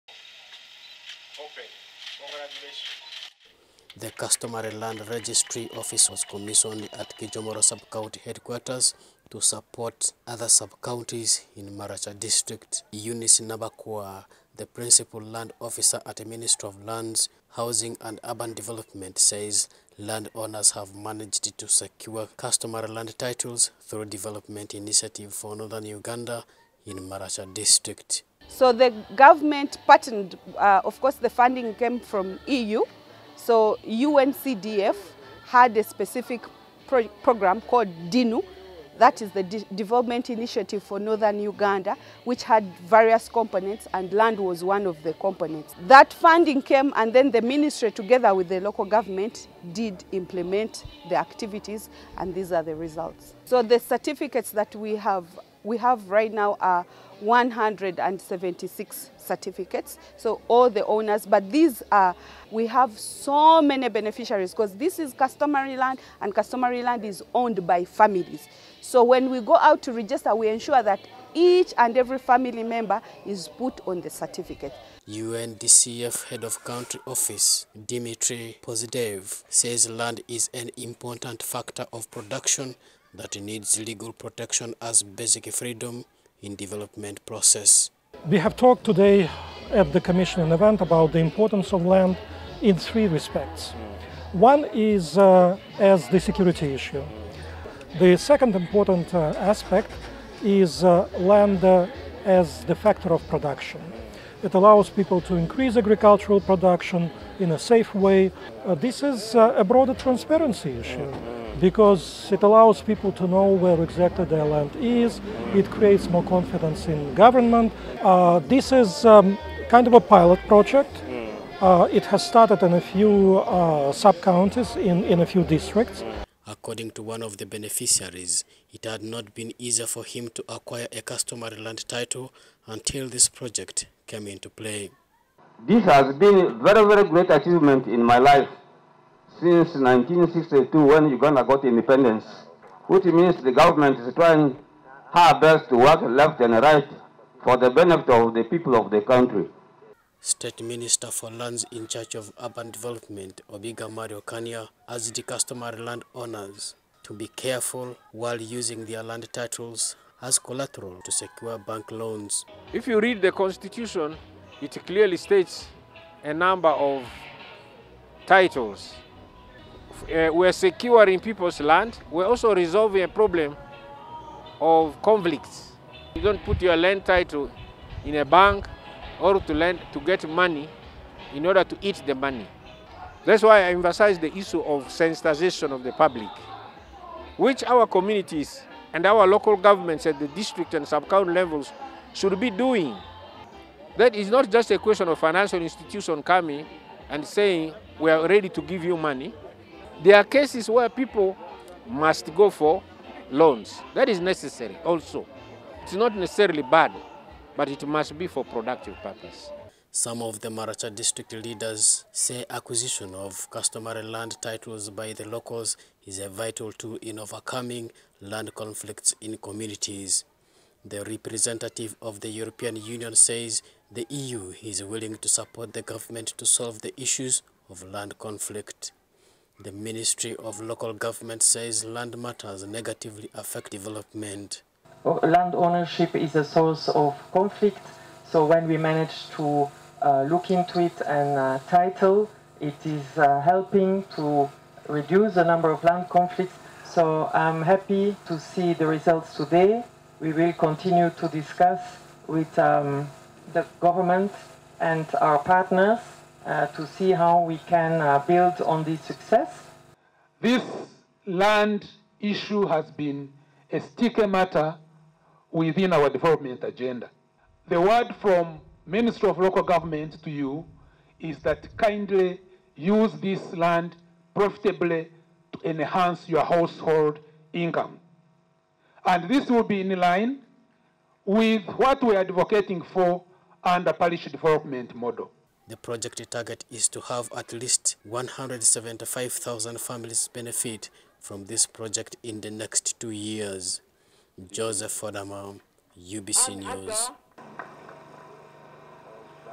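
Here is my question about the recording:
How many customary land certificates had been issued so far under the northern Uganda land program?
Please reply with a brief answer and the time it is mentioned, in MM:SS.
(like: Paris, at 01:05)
176, at 00:57.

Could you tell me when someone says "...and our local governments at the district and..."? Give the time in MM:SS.
03:08.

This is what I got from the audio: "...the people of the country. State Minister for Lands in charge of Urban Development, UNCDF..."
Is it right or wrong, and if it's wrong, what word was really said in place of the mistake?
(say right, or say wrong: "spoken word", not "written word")
wrong: "Obiga", not "UNCDF".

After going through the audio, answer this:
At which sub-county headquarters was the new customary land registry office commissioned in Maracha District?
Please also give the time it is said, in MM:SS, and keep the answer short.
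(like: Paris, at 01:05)
Kijomoro, at 00:07.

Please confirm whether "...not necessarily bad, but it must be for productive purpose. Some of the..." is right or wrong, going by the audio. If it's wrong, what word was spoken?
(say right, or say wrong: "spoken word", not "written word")
right.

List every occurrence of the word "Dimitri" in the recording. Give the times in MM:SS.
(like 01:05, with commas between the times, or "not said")
01:17.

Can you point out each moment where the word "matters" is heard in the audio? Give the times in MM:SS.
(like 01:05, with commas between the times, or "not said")
03:52, 04:24.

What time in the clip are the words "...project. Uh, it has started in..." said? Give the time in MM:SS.
02:00.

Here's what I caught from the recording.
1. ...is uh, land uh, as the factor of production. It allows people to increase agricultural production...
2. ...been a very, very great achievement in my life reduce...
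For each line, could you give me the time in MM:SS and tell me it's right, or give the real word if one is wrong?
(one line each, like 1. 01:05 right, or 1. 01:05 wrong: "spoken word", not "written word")
1. 01:40 right
2. 02:16 wrong: "since", not "reduce".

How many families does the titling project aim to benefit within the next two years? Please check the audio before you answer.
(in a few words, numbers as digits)
175,000.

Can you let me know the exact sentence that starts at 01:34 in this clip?
One is uh, as the security issue.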